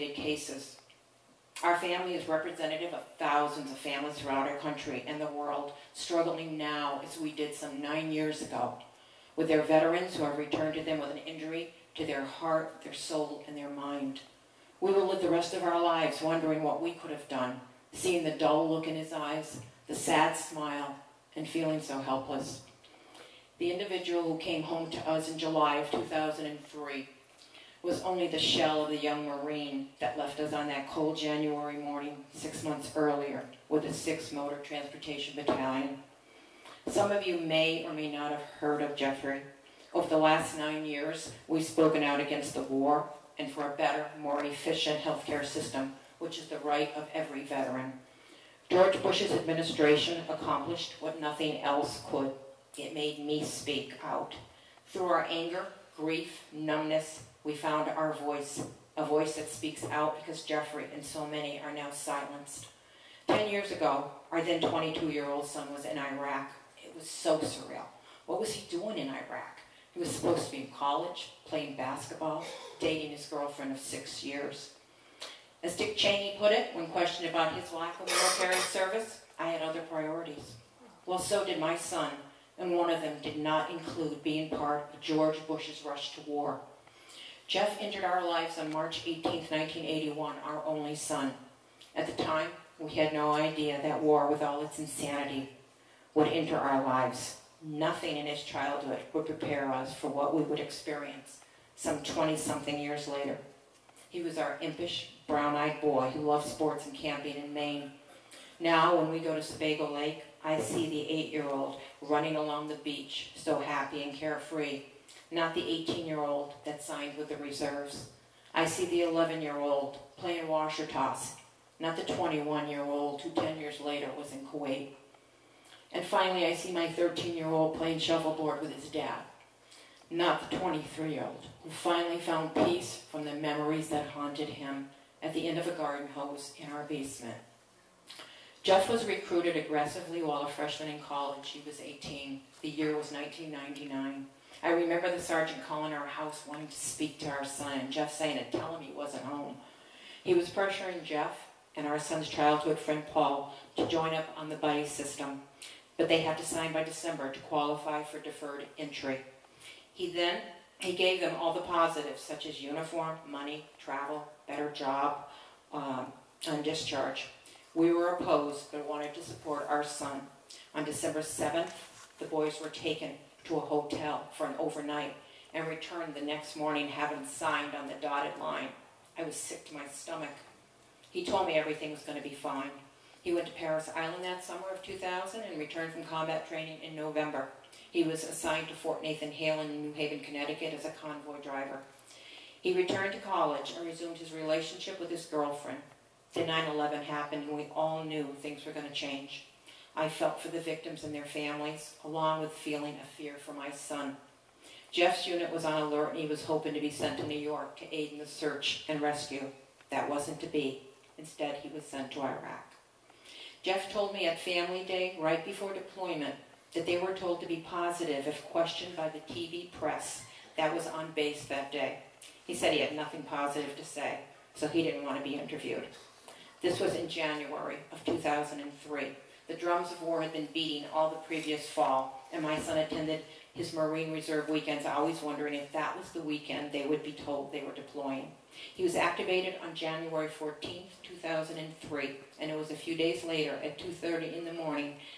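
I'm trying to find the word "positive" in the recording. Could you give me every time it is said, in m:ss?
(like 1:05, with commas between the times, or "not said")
2:41, 3:37, 3:43.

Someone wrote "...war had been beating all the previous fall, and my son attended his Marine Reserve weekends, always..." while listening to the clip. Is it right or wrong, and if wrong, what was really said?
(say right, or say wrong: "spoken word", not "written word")
right.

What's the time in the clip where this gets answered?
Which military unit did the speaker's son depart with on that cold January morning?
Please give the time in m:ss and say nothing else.
0:33.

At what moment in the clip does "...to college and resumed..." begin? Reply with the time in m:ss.
3:13.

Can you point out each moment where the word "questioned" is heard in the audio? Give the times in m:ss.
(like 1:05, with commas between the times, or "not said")
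1:16, 3:38.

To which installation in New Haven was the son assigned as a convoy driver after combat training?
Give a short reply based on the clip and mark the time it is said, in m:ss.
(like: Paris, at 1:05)
Fort Nathan Hale, at 3:08.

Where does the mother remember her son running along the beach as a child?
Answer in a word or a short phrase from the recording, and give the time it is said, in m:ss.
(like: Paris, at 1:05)
Sebago Lake, at 1:49.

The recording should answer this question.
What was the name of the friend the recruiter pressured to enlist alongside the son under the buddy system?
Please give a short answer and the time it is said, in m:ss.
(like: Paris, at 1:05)
Paul, at 2:33.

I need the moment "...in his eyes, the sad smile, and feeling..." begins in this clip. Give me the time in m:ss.
0:18.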